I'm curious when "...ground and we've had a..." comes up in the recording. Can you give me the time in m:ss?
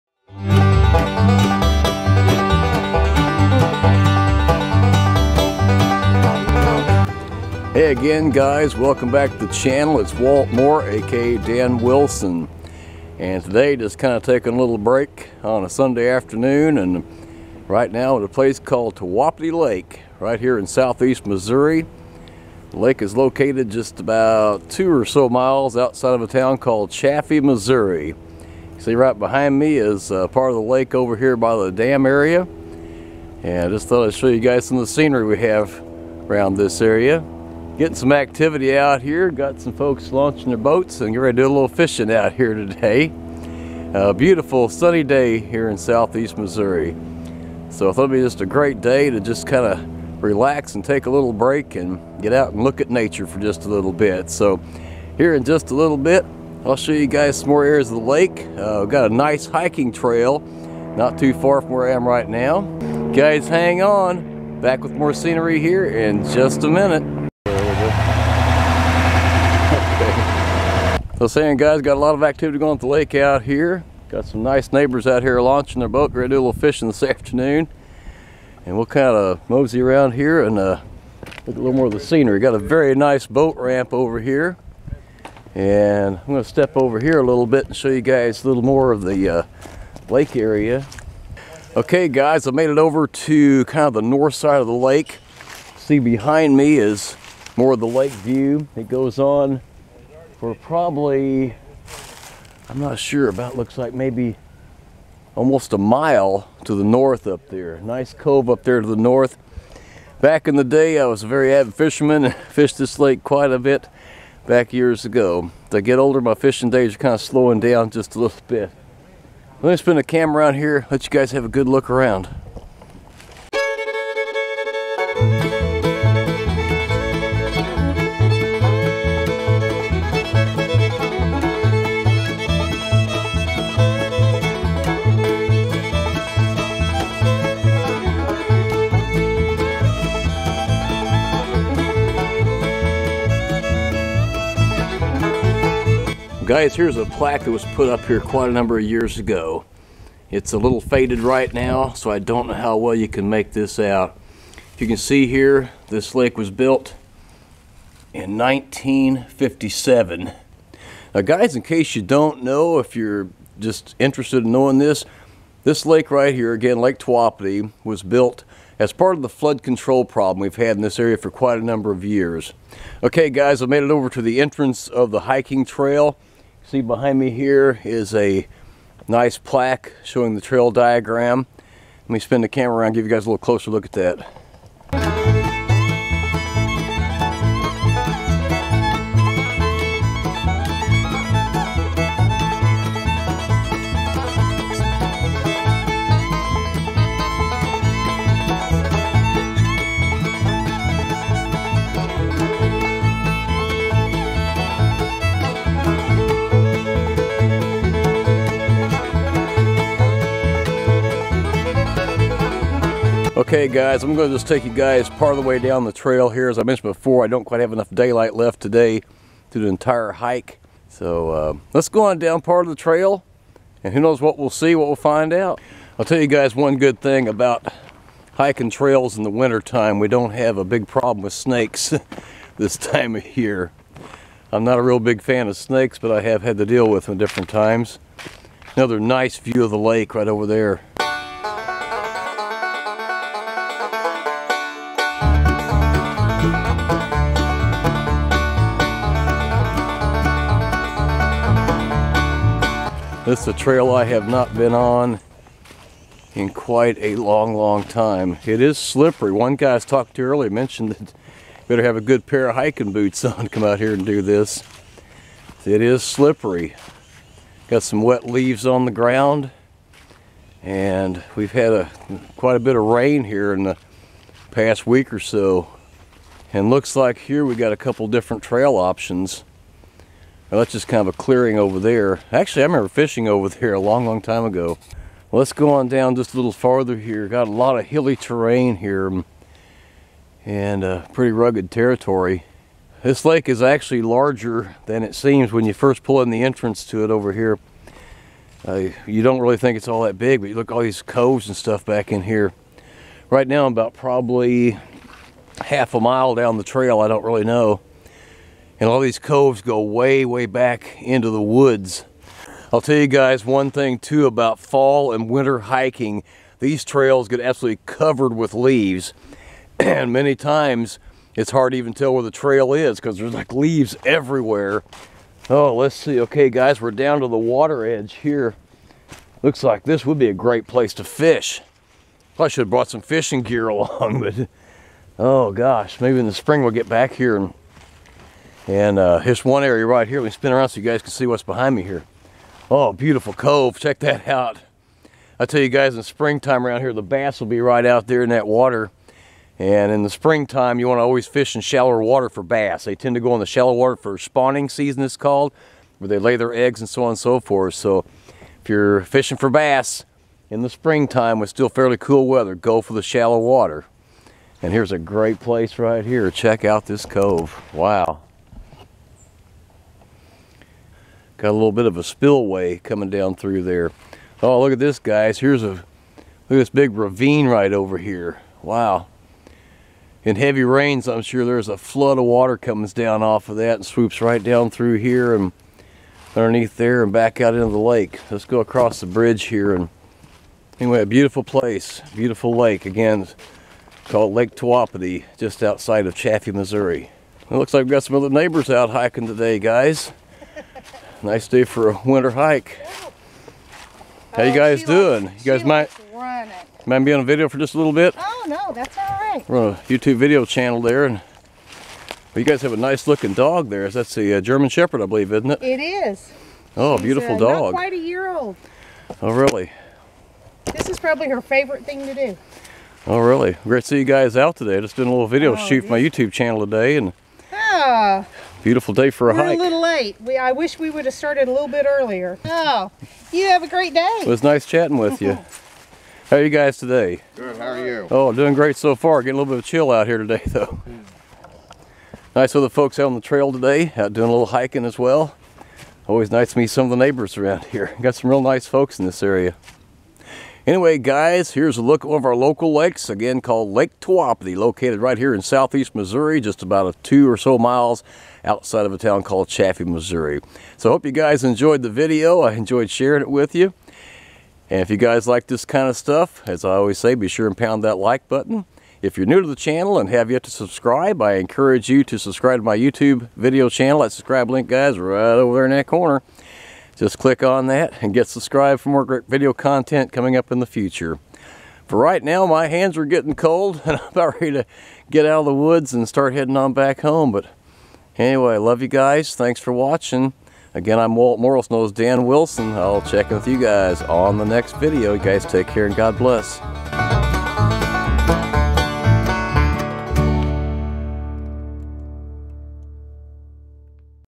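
4:28.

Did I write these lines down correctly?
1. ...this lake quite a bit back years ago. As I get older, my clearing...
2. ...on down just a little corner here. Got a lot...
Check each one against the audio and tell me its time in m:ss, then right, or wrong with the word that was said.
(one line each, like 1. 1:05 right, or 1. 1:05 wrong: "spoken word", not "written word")
1. 1:52 wrong: "fishing", not "clearing"
2. 4:45 wrong: "farther", not "corner".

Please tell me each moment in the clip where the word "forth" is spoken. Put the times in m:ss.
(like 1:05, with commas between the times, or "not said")
5:57.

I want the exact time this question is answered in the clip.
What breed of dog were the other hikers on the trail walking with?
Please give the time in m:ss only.
6:54.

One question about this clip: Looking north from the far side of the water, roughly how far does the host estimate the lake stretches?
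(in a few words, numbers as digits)
Almost a mile.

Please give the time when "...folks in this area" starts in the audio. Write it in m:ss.
7:28.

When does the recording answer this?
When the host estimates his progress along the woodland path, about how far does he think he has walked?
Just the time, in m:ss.
5:05.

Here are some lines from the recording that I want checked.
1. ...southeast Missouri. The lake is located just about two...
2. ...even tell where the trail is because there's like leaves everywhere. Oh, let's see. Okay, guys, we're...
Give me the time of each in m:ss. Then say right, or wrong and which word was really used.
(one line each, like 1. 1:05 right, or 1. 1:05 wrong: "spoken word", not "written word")
1. 0:20 right
2. 5:21 right.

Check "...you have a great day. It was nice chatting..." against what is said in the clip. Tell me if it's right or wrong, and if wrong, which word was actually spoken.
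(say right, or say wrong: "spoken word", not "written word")
right.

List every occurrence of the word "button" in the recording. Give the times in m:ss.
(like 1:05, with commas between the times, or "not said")
7:48.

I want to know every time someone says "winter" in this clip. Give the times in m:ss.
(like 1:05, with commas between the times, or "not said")
3:49, 5:15, 6:42.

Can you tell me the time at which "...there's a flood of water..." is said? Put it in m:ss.
6:21.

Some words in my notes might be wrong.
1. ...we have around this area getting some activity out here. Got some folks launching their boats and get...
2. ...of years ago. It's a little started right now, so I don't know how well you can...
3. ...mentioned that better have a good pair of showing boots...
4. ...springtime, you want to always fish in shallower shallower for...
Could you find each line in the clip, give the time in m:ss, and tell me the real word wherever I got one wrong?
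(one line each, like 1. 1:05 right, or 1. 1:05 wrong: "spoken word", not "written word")
1. 0:35 right
2. 2:28 wrong: "faded", not "started"
3. 4:20 wrong: "hiking", not "showing"
4. 5:50 wrong: "water", not "shallower".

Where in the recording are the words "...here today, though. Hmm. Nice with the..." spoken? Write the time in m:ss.
7:20.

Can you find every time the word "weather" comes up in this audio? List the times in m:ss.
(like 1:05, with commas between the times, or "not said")
6:02.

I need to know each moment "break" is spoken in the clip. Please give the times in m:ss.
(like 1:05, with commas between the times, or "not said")
0:14, 0:51.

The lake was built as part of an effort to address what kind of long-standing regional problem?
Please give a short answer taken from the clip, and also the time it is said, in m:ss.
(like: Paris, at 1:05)
Flood control, at 2:49.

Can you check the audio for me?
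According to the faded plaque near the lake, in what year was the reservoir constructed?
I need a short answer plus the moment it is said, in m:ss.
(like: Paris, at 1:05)
1957, at 2:38.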